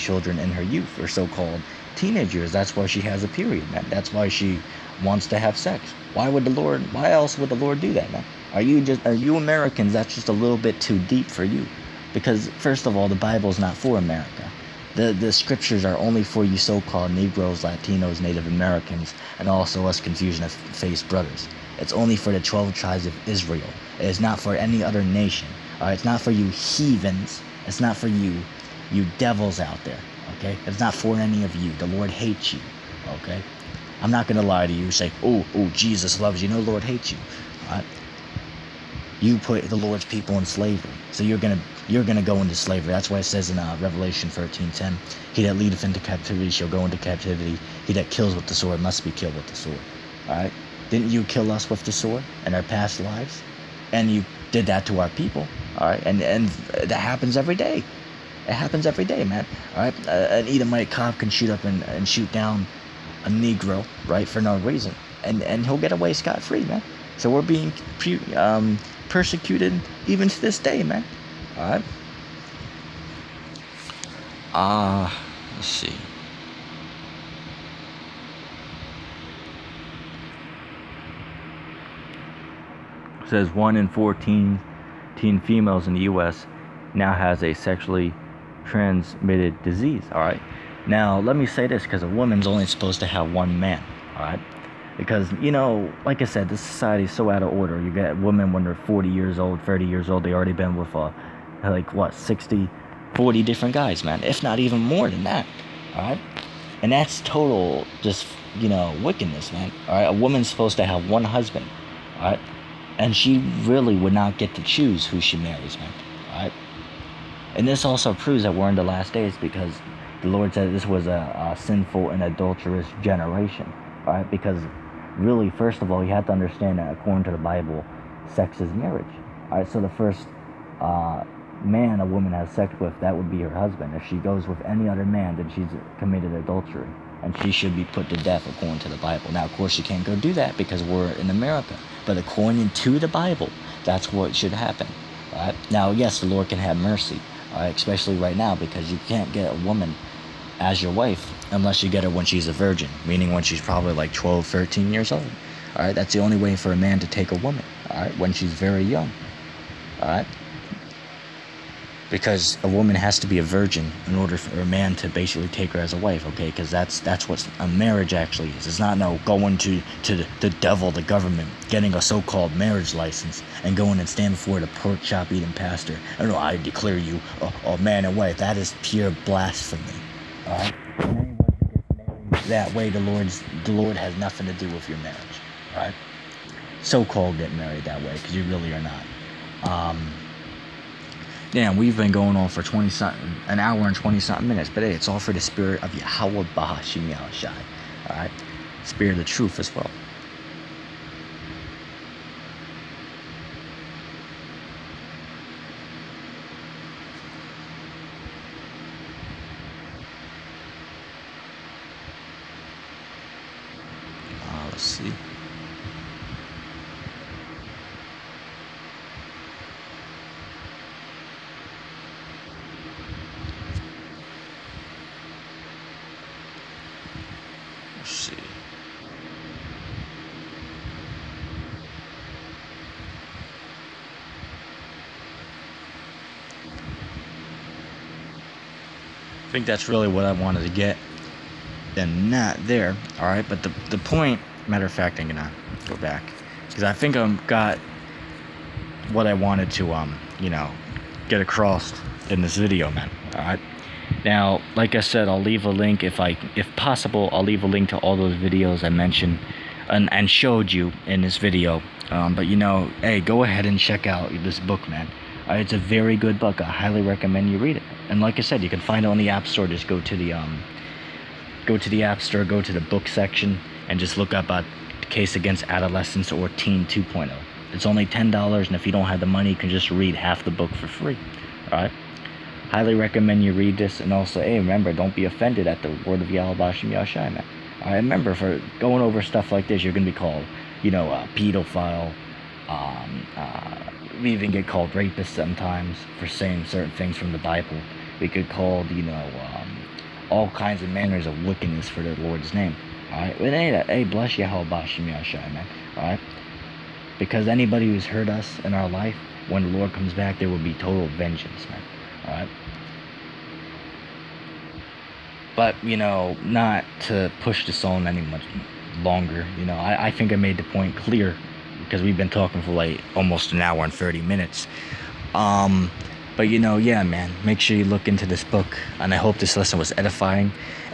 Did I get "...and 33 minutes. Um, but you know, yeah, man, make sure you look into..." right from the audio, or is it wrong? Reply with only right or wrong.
wrong.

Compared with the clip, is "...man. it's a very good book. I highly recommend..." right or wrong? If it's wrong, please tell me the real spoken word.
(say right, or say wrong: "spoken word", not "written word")
right.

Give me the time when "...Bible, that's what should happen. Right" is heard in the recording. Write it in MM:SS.
02:23.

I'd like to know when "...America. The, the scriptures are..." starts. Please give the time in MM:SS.
00:13.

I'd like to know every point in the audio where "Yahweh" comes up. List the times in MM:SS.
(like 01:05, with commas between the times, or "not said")
03:15, 05:04.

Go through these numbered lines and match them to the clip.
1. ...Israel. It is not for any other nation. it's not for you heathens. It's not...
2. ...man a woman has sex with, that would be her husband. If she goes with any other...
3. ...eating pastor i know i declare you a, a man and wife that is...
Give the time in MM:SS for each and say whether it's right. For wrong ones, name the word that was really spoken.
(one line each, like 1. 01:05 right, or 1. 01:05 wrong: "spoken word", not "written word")
1. 00:23 right
2. 02:11 right
3. 02:55 right.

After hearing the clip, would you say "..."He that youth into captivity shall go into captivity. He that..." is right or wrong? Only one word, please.
wrong.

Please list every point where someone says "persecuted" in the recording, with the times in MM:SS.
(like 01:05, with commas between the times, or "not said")
01:09.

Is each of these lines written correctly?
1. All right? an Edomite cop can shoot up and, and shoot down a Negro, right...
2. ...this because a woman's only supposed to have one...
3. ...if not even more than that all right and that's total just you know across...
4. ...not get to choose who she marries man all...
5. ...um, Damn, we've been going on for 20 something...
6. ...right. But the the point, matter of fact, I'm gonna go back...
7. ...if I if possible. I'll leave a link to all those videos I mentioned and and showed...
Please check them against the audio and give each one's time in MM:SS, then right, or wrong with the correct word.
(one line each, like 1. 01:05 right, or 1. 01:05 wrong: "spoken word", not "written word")
1. 00:59 right
2. 01:31 right
3. 01:44 wrong: "wickedness", not "across"
4. 01:54 right
5. 03:09 right
6. 04:03 right
7. 04:16 right.